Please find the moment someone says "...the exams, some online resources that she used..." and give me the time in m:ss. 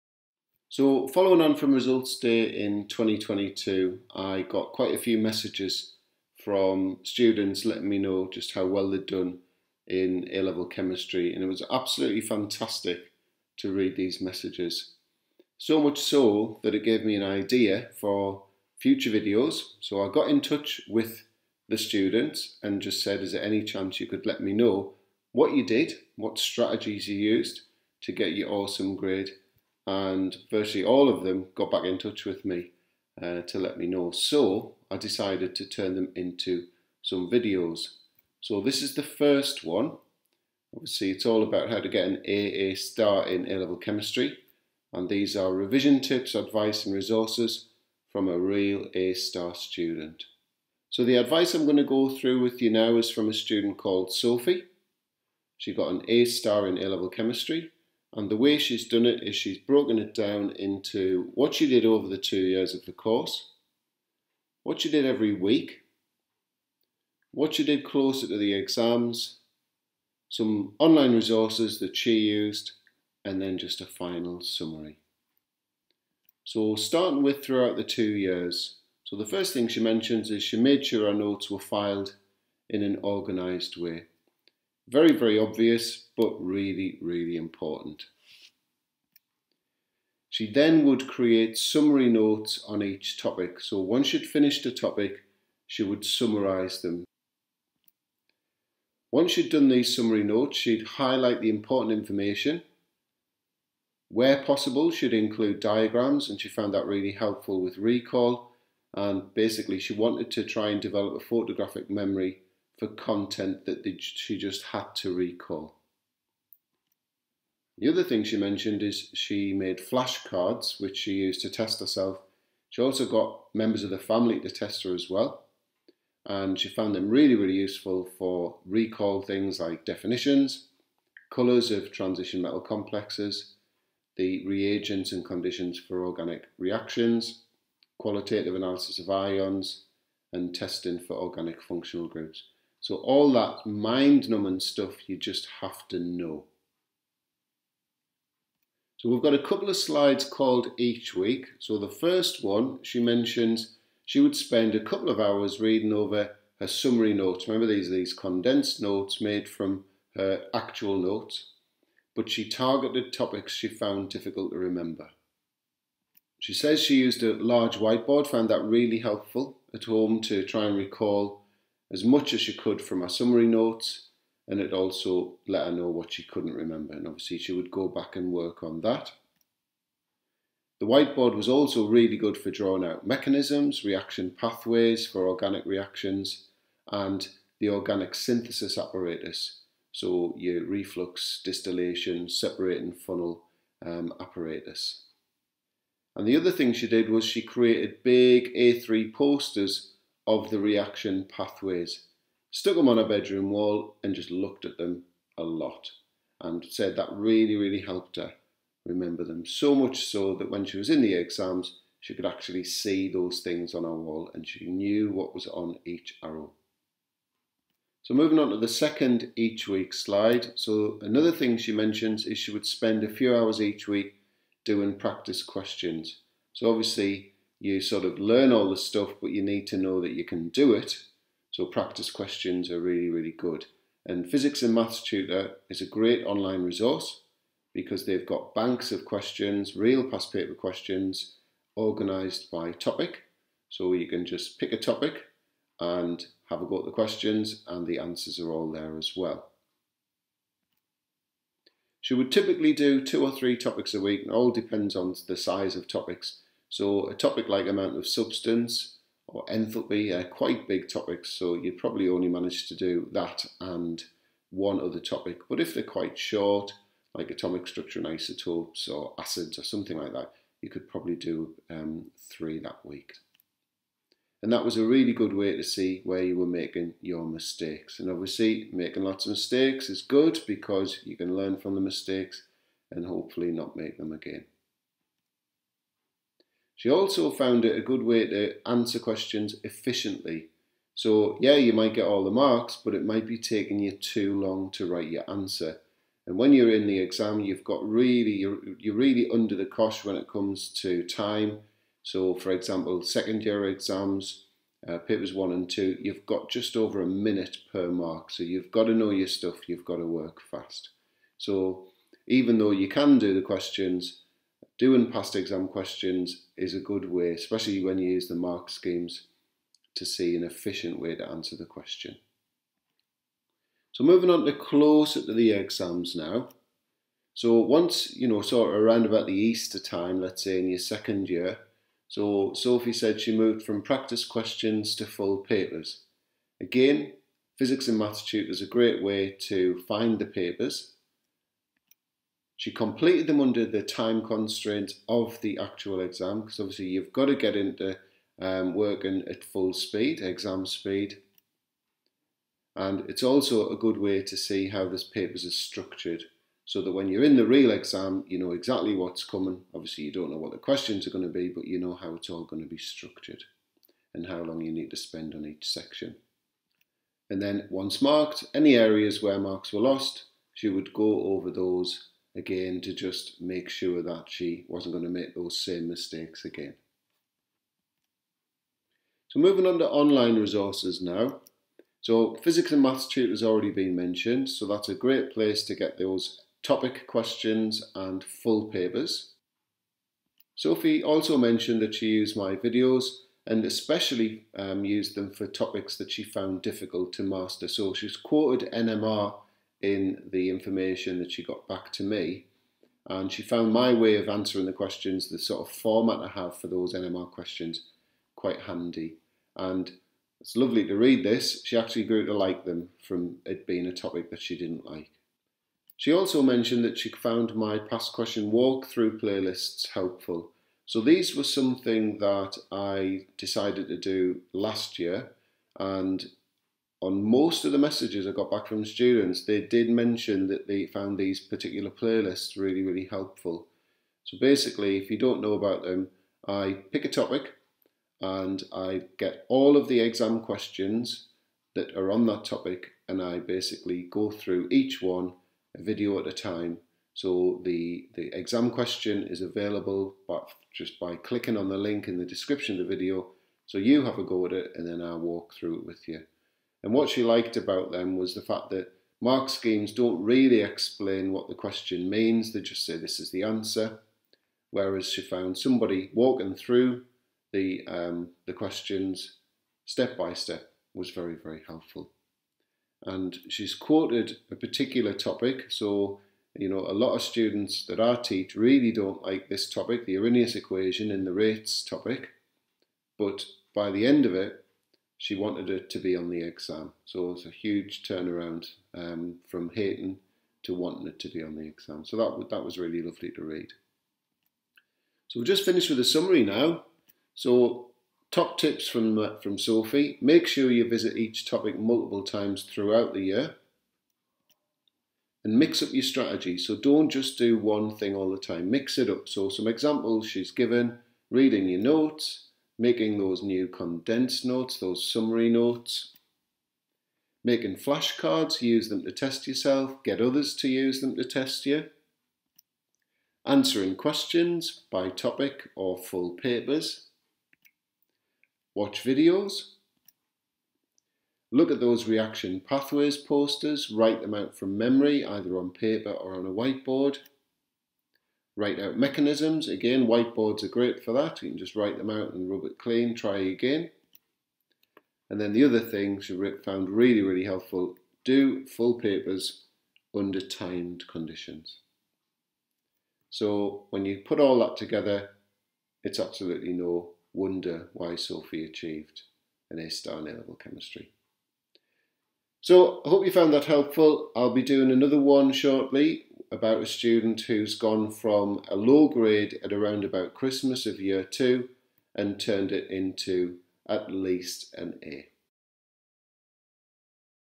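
1:08.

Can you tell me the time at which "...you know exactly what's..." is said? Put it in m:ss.
5:58.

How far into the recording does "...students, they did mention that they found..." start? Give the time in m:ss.
7:08.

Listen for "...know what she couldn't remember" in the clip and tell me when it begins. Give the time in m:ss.
2:55.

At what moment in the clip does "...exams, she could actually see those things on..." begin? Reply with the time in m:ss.
3:31.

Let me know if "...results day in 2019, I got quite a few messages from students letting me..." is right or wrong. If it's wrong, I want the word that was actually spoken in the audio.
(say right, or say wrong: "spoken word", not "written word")
wrong: "2022", not "2019".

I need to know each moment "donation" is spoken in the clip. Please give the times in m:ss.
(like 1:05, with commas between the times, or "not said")
not said.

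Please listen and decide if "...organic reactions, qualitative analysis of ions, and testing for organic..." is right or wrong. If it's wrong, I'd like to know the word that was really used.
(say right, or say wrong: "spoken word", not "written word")
right.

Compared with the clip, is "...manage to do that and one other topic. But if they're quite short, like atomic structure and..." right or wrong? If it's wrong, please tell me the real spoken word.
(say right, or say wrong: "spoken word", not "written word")
right.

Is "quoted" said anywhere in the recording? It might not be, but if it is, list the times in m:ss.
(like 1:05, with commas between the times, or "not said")
6:38, 7:53.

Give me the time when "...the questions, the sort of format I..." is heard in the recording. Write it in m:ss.
6:44.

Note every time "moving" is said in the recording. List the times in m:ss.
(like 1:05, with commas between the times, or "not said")
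3:38, 5:24, 6:19.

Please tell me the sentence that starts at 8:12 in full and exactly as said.
So that, that was really lovely to read.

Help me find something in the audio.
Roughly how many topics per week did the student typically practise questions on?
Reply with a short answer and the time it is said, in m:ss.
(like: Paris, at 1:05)
2 or 3, at 4:13.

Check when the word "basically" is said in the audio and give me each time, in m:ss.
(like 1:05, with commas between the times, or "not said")
1:49, 7:14, 7:23.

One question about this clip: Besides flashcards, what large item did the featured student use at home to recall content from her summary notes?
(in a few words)
A large whiteboard.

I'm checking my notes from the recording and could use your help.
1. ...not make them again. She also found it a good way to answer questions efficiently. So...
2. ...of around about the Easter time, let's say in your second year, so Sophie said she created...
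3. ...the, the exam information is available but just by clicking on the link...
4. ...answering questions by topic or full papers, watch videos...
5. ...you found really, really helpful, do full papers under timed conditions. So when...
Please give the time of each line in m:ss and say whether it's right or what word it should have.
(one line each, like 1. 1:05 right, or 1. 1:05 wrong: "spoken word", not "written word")
1. 4:43 right
2. 5:28 wrong: "moved", not "created"
3. 7:27 wrong: "question", not "information"
4. 8:43 right
5. 9:06 right.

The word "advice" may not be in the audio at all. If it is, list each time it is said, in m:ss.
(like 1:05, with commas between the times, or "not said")
0:46, 0:51.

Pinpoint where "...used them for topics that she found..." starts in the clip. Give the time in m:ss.
6:34.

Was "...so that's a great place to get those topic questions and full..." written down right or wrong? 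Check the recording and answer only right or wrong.
right.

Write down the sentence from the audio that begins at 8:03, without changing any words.
But by the end of it, she wanted her to be on the exam.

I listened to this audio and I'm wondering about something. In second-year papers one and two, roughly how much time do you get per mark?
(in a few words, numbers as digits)
Just over a minute.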